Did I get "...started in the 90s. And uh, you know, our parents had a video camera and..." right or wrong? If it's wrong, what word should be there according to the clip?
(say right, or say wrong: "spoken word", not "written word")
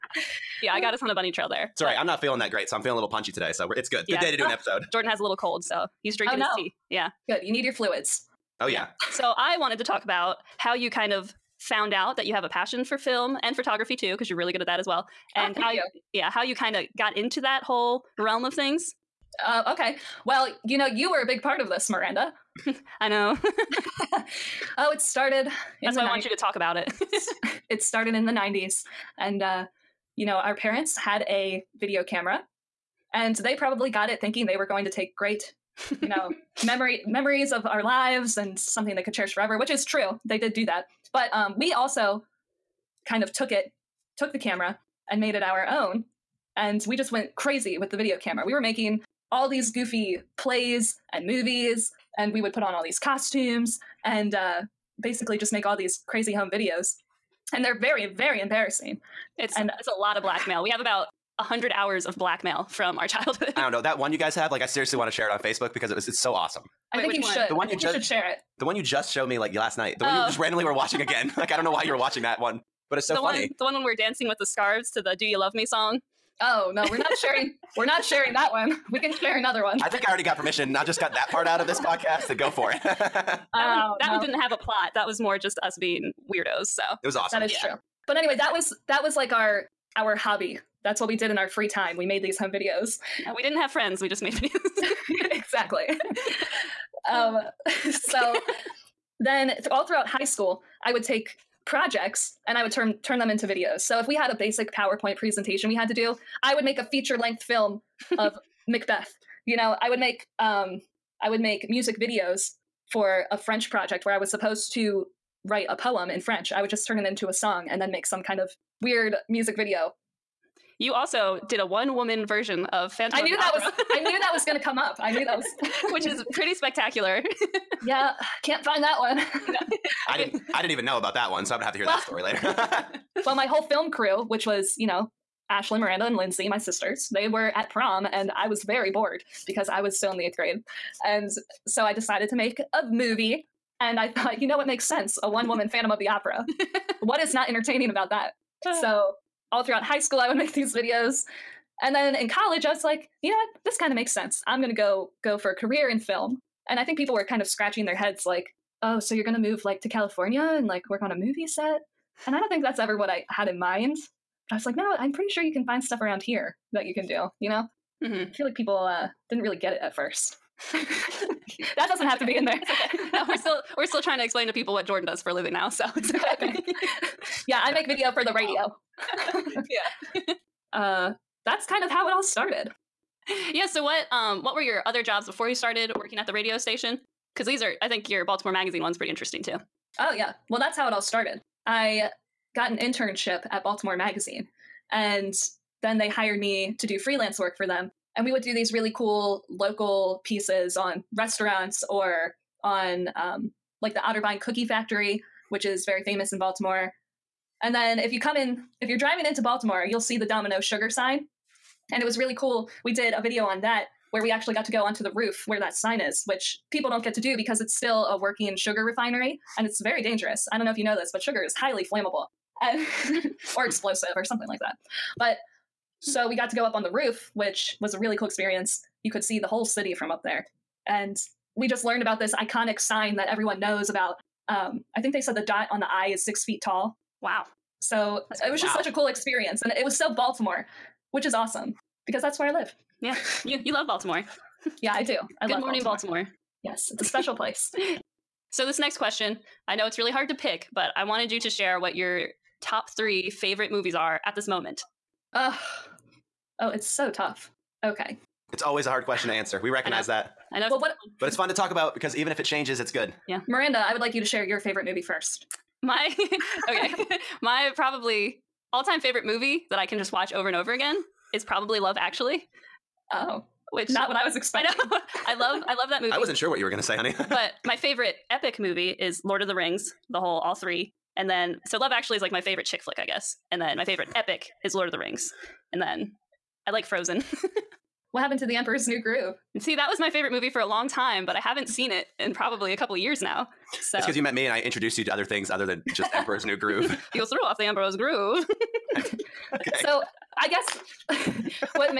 right.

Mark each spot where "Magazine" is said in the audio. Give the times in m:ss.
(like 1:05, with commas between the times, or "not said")
3:08, 3:13.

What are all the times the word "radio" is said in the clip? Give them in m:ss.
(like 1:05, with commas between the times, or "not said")
2:58, 3:06.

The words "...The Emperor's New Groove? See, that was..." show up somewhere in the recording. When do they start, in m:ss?
4:48.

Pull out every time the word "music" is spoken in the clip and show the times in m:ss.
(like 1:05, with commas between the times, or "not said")
1:51, 1:59.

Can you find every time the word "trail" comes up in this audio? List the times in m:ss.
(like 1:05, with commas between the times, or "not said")
0:01.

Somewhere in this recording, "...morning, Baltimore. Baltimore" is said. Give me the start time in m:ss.
4:05.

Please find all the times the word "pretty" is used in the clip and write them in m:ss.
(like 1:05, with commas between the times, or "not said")
2:06, 2:45, 3:08.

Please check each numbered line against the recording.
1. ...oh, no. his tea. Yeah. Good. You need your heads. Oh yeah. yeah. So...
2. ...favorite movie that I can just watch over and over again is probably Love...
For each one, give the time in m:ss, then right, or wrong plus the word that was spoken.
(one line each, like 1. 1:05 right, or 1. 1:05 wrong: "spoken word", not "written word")
1. 0:06 wrong: "fluids", not "heads"
2. 4:28 right.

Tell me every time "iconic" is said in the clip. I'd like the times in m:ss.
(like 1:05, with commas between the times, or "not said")
3:52.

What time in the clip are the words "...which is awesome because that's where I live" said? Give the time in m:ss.
4:01.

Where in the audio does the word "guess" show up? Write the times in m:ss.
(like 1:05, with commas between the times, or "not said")
4:43, 5:00.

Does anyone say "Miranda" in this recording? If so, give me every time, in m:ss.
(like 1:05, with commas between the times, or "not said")
0:21, 2:15, 4:23.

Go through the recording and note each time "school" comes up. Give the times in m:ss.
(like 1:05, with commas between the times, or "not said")
1:40, 2:29.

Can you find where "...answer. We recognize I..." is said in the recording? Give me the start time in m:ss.
4:19.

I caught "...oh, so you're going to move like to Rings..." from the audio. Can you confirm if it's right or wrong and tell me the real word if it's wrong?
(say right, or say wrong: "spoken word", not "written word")
wrong: "California", not "Rings".